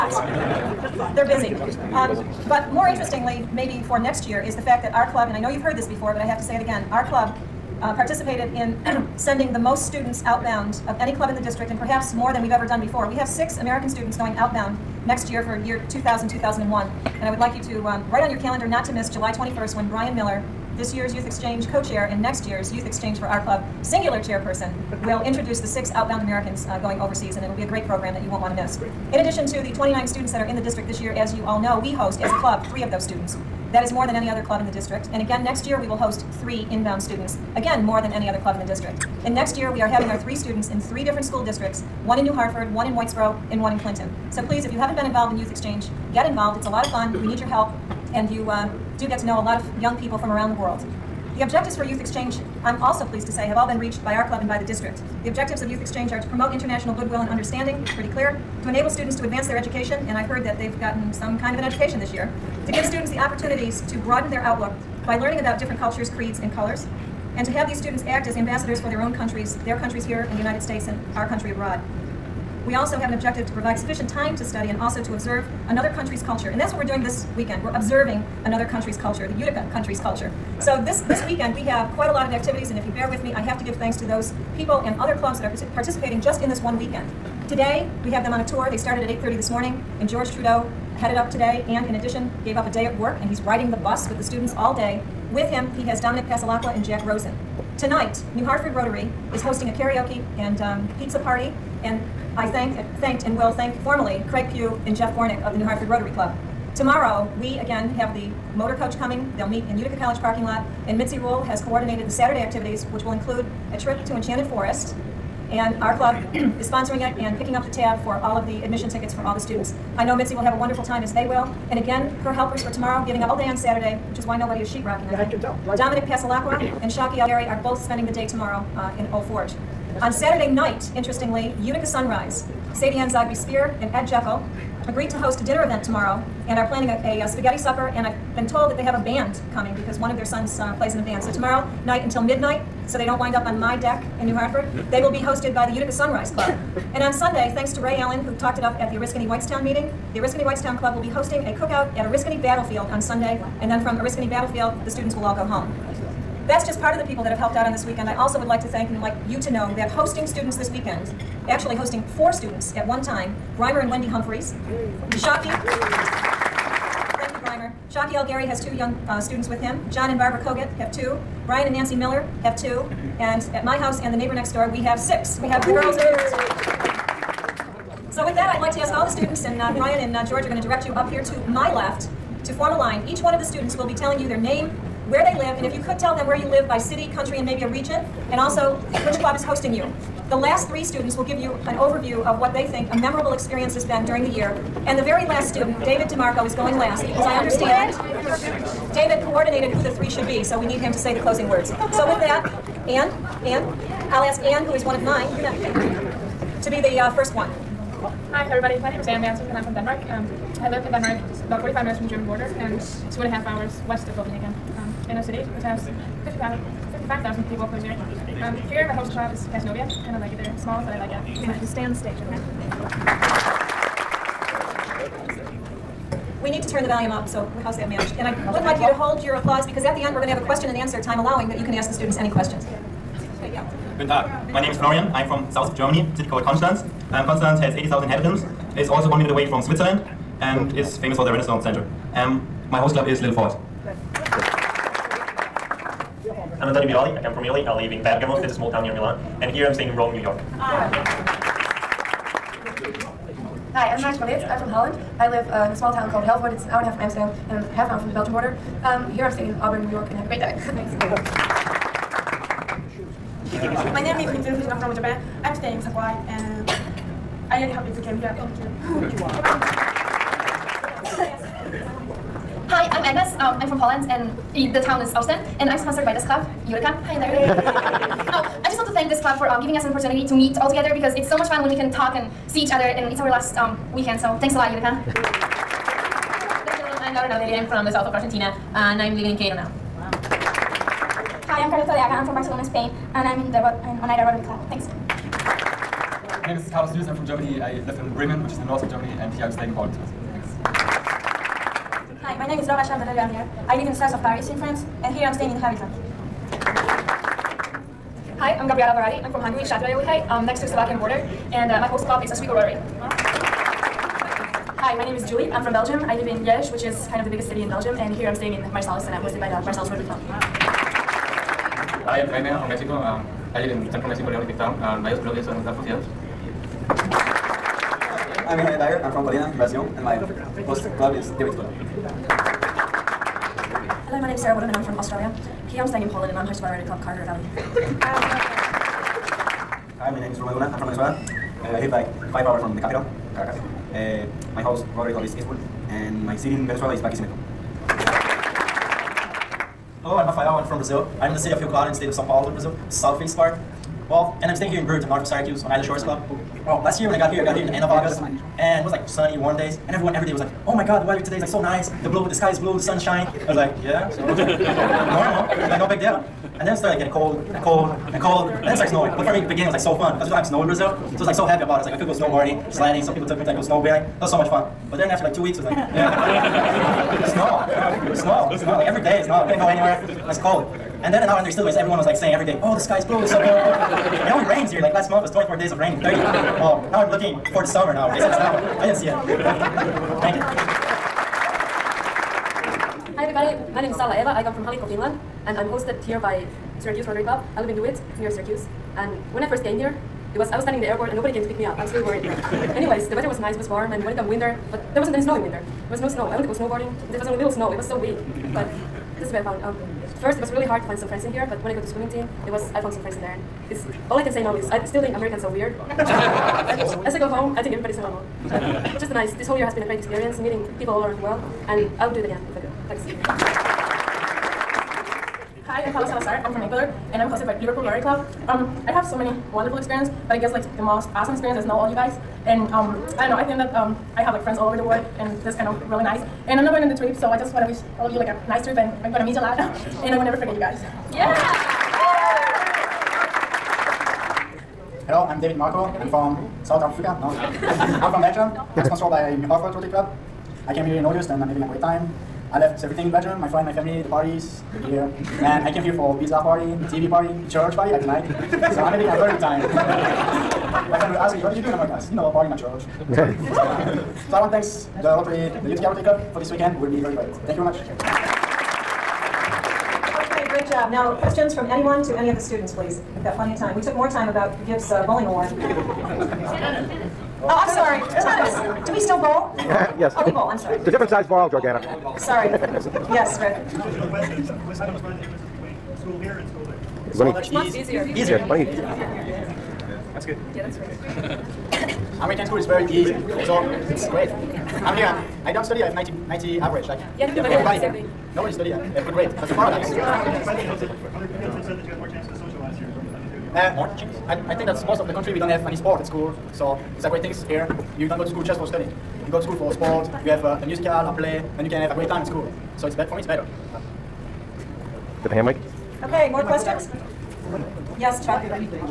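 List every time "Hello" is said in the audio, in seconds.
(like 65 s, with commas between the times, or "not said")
334 s, 350 s, 445 s.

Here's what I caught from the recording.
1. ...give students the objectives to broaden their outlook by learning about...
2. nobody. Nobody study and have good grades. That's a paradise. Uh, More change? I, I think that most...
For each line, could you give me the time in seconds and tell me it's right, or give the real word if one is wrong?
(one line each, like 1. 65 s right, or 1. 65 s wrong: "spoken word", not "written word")
1. 62 s wrong: "opportunities", not "objectives"
2. 497 s wrong: "everybody", not "nobody".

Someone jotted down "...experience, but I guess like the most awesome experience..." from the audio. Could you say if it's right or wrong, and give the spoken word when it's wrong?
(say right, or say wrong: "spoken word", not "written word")
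right.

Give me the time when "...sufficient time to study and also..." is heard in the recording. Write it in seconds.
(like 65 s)
73 s.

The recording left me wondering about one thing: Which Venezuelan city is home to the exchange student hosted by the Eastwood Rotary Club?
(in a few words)
Barquisimeto.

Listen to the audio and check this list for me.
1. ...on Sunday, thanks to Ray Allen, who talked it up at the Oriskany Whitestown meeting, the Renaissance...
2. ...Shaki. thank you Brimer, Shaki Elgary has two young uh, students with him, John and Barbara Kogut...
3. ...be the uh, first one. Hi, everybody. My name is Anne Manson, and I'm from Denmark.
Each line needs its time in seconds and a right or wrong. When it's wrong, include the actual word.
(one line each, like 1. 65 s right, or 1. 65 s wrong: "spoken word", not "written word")
1. 147 s wrong: "Oriskany", not "Renaissance"
2. 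165 s right
3. 206 s right.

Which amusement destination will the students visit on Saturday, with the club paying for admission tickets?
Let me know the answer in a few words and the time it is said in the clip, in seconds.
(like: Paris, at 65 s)
Enchanted Forest, at 114 s.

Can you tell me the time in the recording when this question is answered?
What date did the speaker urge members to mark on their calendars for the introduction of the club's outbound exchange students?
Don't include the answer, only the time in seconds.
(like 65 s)
19 s.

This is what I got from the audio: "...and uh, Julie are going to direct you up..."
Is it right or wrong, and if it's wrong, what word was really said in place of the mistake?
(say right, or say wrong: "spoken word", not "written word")
wrong: "George", not "Julie".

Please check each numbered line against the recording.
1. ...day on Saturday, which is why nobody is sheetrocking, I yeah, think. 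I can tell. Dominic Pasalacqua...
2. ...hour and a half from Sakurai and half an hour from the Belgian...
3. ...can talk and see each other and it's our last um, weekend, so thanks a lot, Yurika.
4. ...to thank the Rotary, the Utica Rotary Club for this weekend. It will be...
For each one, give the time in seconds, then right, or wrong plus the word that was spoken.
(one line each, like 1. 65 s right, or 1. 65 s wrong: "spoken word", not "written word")
1. 123 s right
2. 256 s wrong: "Amsterdam", not "Sakurai"
3. 281 s right
4. 464 s right.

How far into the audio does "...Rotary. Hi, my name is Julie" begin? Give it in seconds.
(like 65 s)
312 s.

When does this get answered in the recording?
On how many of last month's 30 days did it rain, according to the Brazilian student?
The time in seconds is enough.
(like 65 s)
385 s.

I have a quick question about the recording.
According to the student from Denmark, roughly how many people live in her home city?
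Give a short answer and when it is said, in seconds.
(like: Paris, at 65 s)
55,000, at 216 s.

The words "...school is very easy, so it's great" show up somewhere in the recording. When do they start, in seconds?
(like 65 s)
492 s.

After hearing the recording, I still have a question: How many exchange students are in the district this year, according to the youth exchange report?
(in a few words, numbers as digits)
29.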